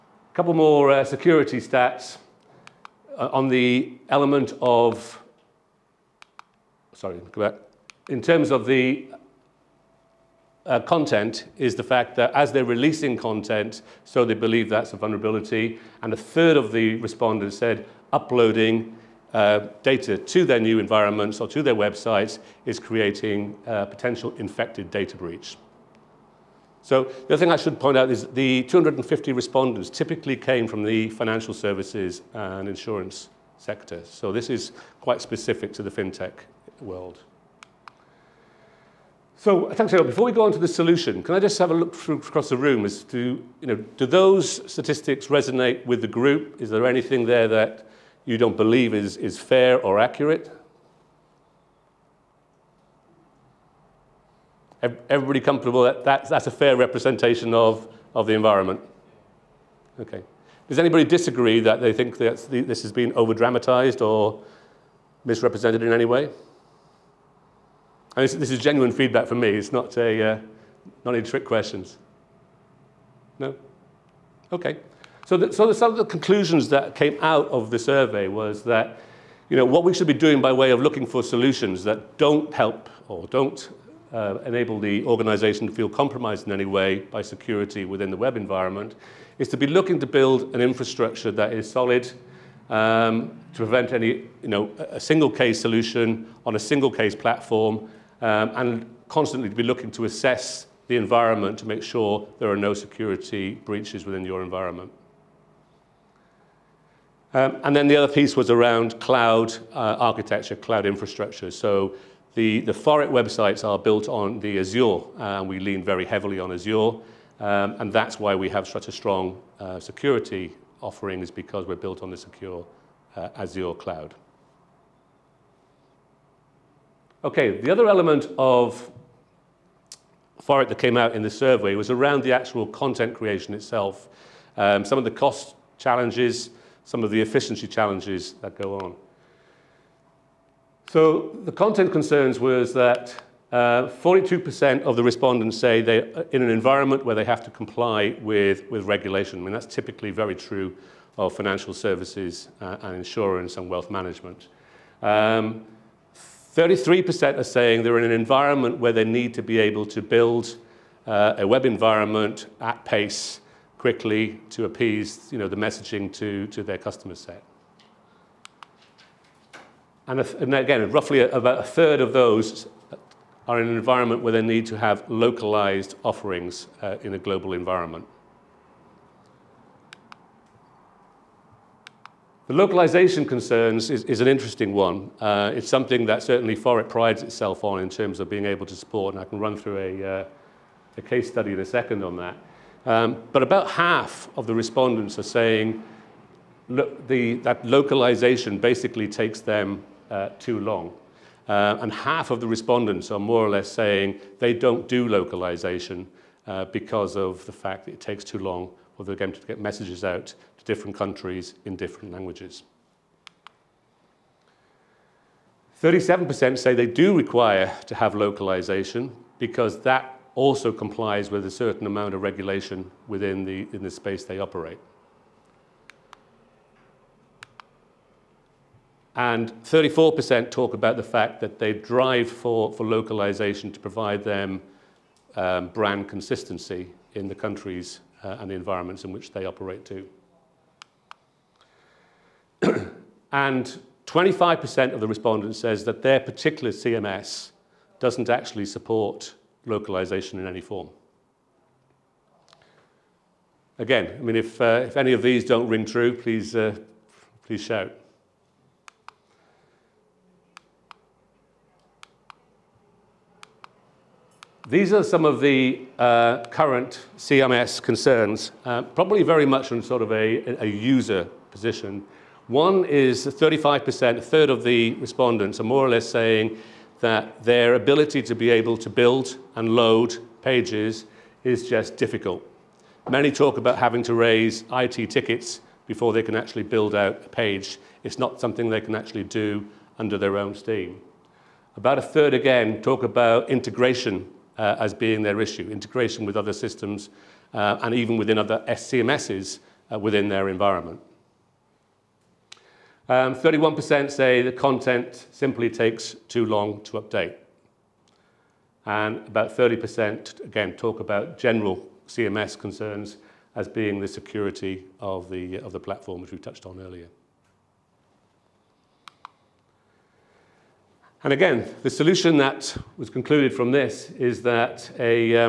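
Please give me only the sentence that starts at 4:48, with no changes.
It's not something they can actually do under their own steam.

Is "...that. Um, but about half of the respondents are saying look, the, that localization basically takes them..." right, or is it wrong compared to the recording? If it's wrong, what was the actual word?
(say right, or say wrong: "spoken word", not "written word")
right.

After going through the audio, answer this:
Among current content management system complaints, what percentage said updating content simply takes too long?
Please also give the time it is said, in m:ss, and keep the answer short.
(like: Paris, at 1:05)
31%, at 5:03.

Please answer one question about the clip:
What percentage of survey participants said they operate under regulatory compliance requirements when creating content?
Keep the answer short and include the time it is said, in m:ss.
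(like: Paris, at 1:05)
42%, at 2:23.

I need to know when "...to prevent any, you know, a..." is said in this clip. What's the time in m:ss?
1:33.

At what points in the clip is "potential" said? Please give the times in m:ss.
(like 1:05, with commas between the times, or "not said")
0:23.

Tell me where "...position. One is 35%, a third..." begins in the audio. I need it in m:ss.
4:31.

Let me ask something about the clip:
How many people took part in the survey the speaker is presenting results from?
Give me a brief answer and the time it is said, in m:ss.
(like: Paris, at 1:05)
250, at 0:28.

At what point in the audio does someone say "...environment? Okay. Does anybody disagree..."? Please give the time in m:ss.
0:58.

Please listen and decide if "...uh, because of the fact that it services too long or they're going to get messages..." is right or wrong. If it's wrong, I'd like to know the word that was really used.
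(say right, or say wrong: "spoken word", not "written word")
wrong: "takes", not "services".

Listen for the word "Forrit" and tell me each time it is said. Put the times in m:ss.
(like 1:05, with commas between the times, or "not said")
2:10, 3:06.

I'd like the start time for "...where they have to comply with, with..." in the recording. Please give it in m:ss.
2:27.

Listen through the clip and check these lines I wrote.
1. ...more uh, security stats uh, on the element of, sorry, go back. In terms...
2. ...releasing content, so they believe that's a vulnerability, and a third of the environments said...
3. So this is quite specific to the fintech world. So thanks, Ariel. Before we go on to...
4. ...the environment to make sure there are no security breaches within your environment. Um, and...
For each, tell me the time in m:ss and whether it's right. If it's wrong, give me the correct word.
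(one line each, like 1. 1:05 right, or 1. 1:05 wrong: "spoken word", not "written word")
1. 0:00 right
2. 0:12 wrong: "respondents", not "environments"
3. 0:34 right
4. 1:40 right.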